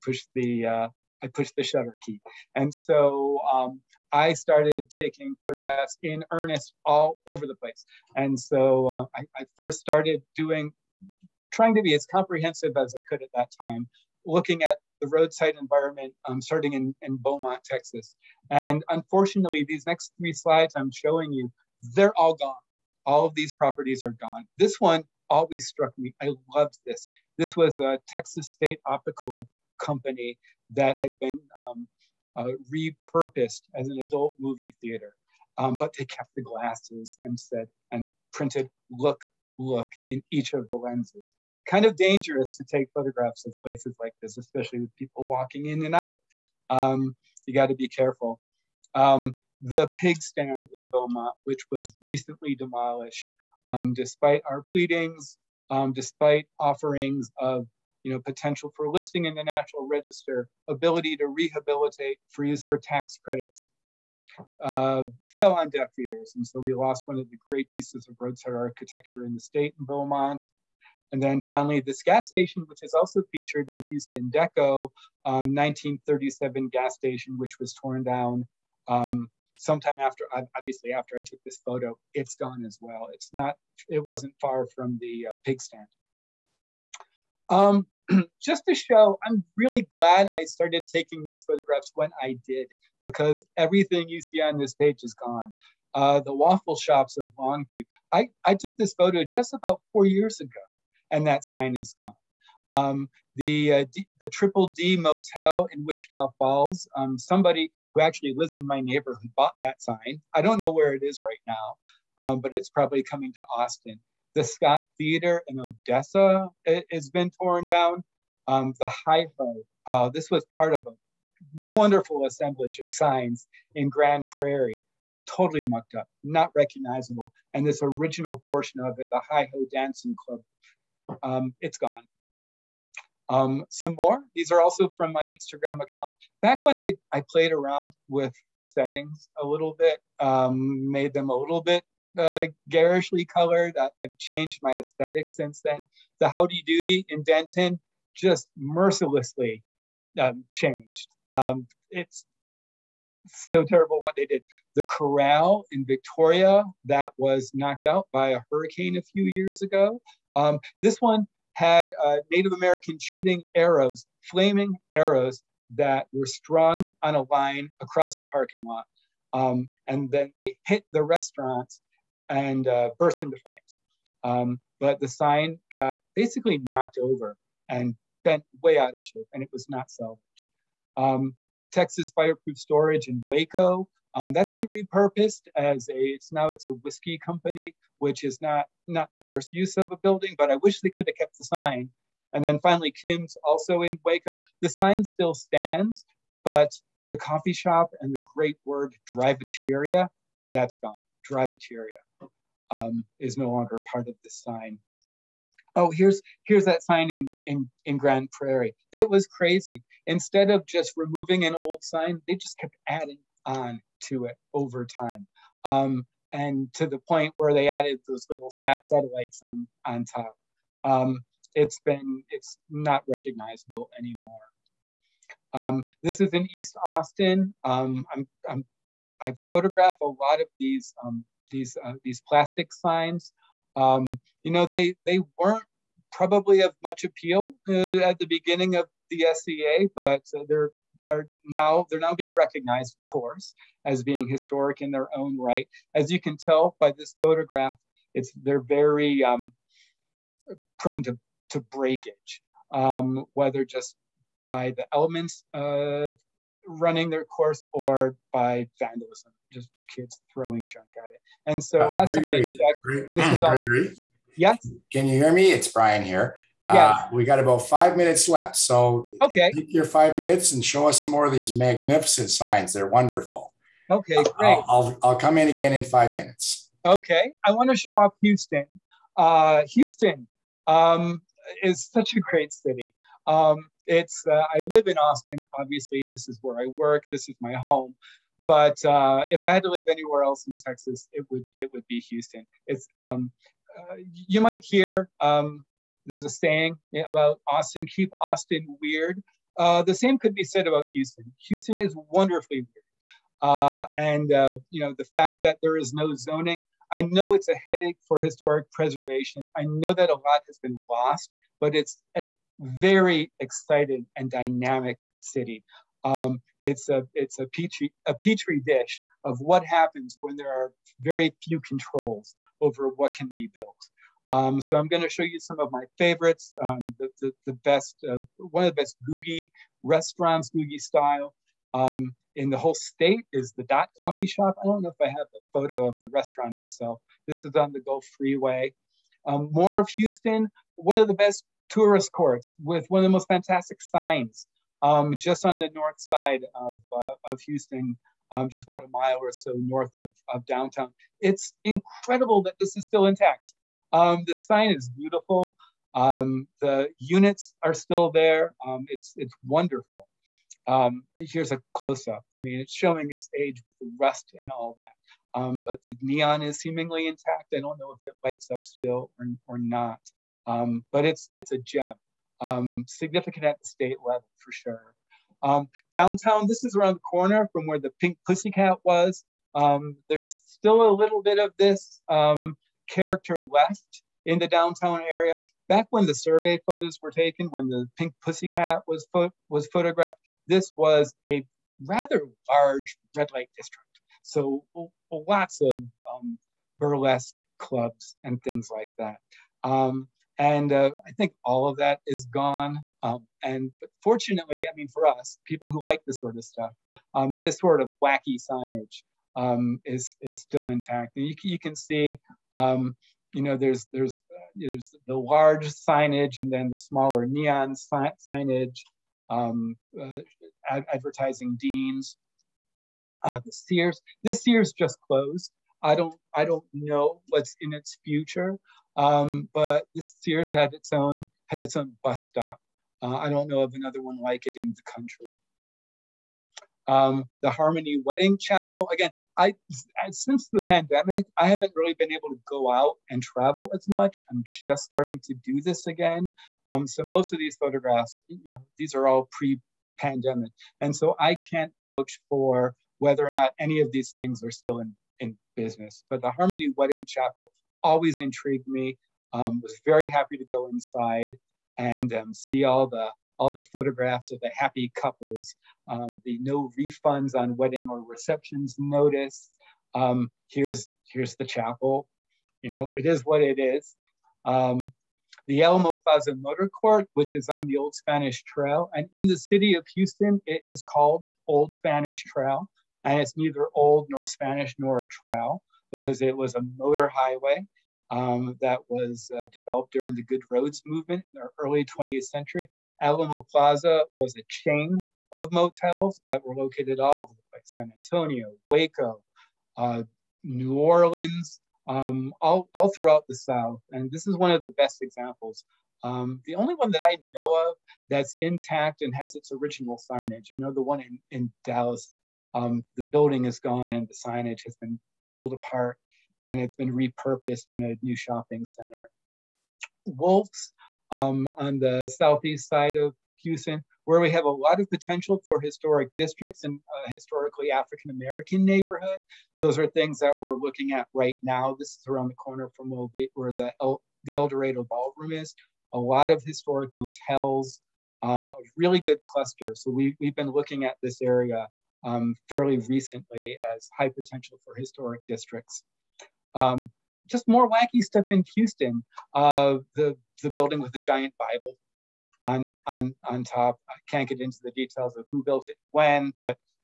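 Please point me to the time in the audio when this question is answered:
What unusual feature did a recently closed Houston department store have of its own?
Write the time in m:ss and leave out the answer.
7:12.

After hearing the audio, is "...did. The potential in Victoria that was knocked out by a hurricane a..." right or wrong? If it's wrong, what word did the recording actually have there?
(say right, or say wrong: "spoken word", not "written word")
wrong: "corral", not "potential".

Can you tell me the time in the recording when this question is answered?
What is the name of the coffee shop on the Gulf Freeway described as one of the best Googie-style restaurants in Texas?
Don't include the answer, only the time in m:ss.
5:33.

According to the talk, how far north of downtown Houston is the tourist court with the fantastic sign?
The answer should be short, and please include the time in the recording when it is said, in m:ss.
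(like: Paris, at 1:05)
about a mile, at 5:48.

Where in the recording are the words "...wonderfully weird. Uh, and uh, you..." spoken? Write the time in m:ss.
5:02.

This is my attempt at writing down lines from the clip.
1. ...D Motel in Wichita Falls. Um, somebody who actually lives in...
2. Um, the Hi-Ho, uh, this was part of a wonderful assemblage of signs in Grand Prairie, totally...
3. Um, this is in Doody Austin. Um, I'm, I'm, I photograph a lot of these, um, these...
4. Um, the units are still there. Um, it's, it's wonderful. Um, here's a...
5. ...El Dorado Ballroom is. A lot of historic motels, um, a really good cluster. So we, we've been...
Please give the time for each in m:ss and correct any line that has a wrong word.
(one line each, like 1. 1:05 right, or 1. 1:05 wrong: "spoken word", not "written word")
1. 1:44 right
2. 1:58 right
3. 3:45 wrong: "East", not "Doody"
4. 5:55 right
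5. 8:54 right.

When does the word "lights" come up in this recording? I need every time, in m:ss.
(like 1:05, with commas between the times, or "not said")
6:08, 6:33.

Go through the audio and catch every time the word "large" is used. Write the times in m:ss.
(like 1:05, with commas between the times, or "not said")
6:32, 6:55.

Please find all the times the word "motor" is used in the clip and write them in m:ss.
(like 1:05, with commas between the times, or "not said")
7:56, 8:06.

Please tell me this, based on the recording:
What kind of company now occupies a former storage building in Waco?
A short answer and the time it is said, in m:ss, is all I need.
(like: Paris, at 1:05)
whiskey company, at 3:06.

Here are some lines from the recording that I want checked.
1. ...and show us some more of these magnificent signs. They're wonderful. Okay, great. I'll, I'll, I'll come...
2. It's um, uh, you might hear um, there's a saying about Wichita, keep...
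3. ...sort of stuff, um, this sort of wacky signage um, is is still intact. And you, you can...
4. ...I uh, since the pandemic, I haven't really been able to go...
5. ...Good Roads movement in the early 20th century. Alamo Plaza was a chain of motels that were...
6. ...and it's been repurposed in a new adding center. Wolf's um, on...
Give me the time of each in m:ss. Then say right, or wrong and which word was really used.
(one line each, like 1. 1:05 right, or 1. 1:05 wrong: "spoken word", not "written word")
1. 4:30 right
2. 4:52 wrong: "Austin", not "Wichita"
3. 6:46 right
4. 7:19 right
5. 8:10 right
6. 8:36 wrong: "shopping", not "adding".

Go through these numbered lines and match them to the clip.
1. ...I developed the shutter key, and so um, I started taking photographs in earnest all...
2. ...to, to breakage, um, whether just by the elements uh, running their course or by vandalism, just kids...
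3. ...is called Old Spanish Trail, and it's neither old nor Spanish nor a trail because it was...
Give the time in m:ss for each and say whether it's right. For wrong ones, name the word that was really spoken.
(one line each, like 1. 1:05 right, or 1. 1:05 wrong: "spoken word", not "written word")
1. 0:01 wrong: "pushed", not "developed"
2. 4:11 right
3. 8:00 right.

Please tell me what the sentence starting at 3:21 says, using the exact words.
Drivateria um, is no longer part of the sign.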